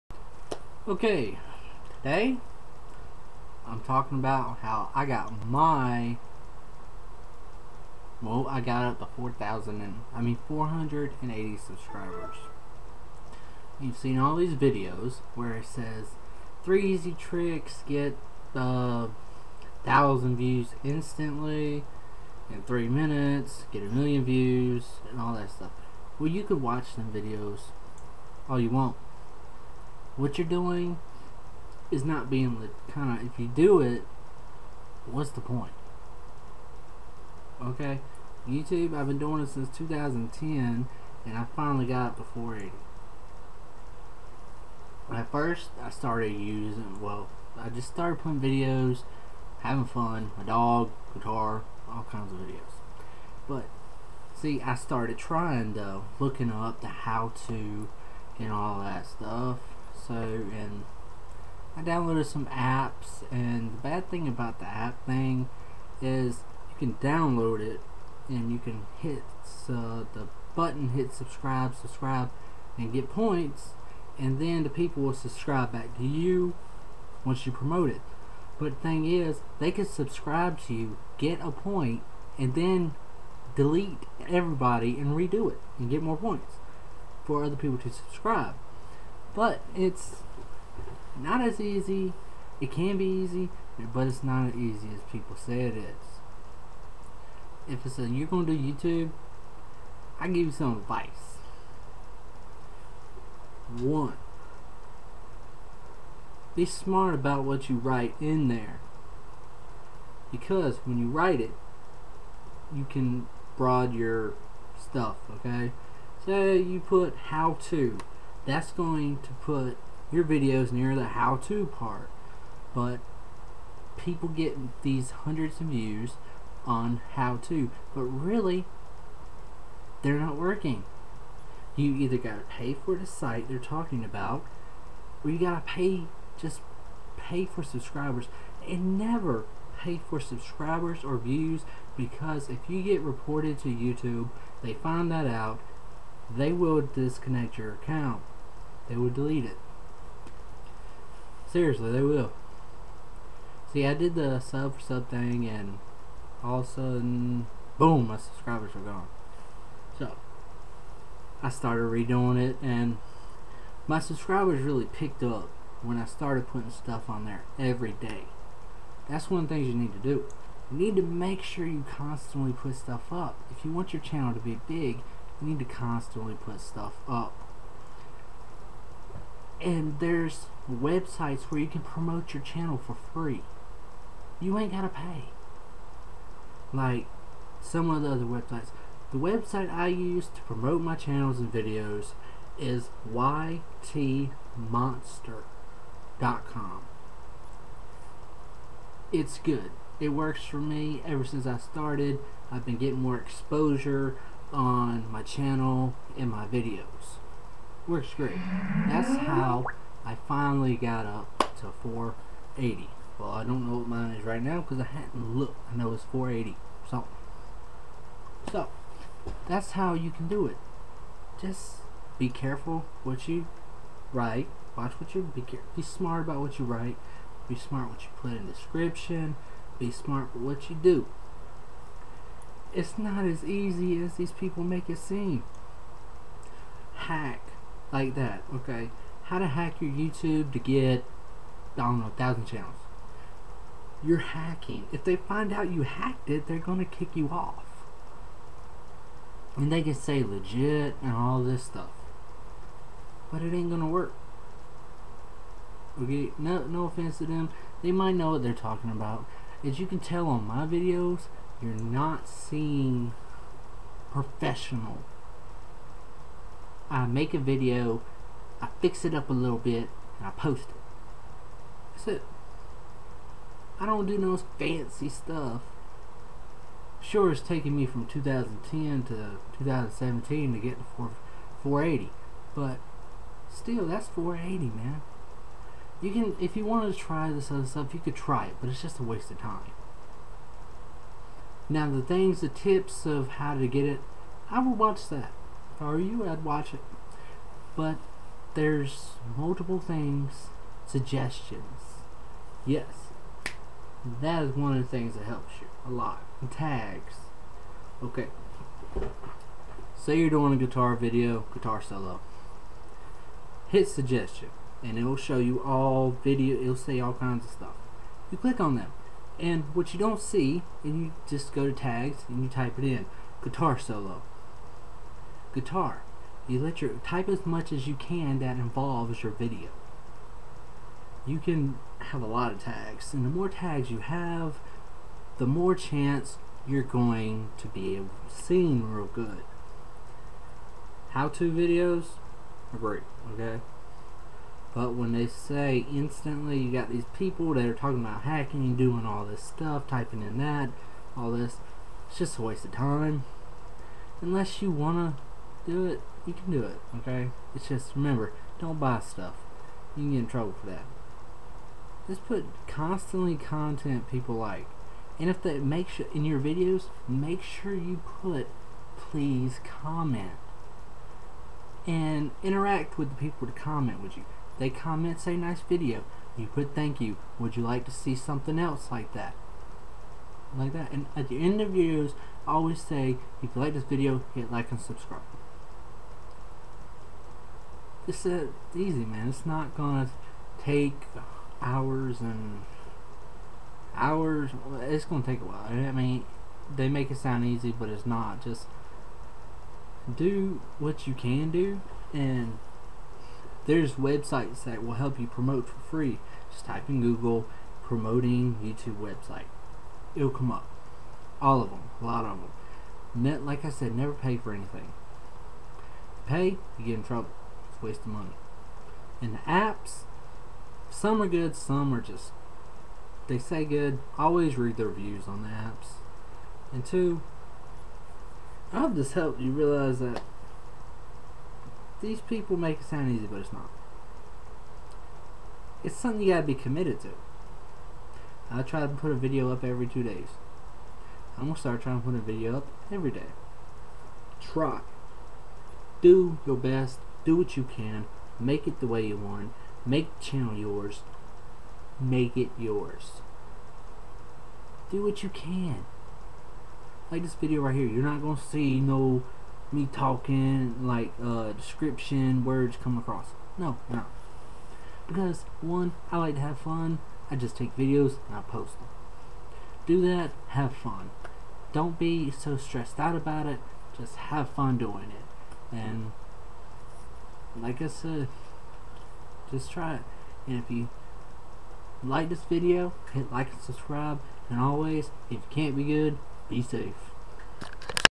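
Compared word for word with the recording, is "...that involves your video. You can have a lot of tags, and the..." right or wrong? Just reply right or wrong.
right.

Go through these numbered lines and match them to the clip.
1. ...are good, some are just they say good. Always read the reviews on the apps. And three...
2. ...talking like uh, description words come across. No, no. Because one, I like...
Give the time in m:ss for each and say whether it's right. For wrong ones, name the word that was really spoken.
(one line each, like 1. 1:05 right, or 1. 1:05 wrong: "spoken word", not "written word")
1. 7:01 wrong: "two", not "three"
2. 7:39 right.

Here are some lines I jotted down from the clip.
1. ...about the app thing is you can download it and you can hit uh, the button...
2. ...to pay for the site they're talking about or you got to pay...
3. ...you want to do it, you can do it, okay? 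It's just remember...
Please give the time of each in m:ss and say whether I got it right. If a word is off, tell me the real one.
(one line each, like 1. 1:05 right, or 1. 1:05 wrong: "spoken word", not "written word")
1. 1:04 right
2. 2:12 right
3. 5:54 right.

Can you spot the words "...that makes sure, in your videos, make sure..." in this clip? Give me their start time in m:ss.
6:05.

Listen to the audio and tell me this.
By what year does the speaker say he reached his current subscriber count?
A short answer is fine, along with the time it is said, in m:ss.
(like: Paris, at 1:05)
2017, at 4:39.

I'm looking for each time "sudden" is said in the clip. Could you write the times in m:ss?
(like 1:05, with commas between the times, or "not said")
2:36.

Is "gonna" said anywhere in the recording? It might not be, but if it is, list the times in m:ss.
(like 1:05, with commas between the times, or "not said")
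1:38, 4:06, 4:13, 6:29, 6:35, 7:21, 7:38.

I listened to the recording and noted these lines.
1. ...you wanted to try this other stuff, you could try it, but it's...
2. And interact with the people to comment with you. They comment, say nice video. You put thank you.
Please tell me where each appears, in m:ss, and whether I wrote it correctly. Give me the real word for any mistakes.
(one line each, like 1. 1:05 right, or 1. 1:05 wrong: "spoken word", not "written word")
1. 4:46 right
2. 6:11 right.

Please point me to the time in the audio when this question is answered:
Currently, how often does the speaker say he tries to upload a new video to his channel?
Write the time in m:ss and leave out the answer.
7:19.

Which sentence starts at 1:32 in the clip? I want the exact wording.
It can be easy, but it's not as easy as people say it is.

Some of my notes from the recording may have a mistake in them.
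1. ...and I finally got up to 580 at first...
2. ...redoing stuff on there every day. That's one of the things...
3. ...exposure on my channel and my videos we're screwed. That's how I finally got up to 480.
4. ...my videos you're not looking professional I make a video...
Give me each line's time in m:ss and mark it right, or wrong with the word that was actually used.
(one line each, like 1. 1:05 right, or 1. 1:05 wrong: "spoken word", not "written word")
1. 0:41 wrong: "480", not "580"
2. 2:46 wrong: "putting", not "redoing"
3. 3:23 right
4. 4:20 wrong: "seeing", not "looking".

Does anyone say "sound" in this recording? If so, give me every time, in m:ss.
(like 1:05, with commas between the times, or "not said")
6:37, 7:12.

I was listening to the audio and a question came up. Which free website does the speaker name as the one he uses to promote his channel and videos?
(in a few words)
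ytmonster.com.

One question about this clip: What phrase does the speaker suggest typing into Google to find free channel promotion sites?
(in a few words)
promoting YouTube website.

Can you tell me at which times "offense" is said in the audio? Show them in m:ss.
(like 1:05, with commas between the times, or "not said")
4:16.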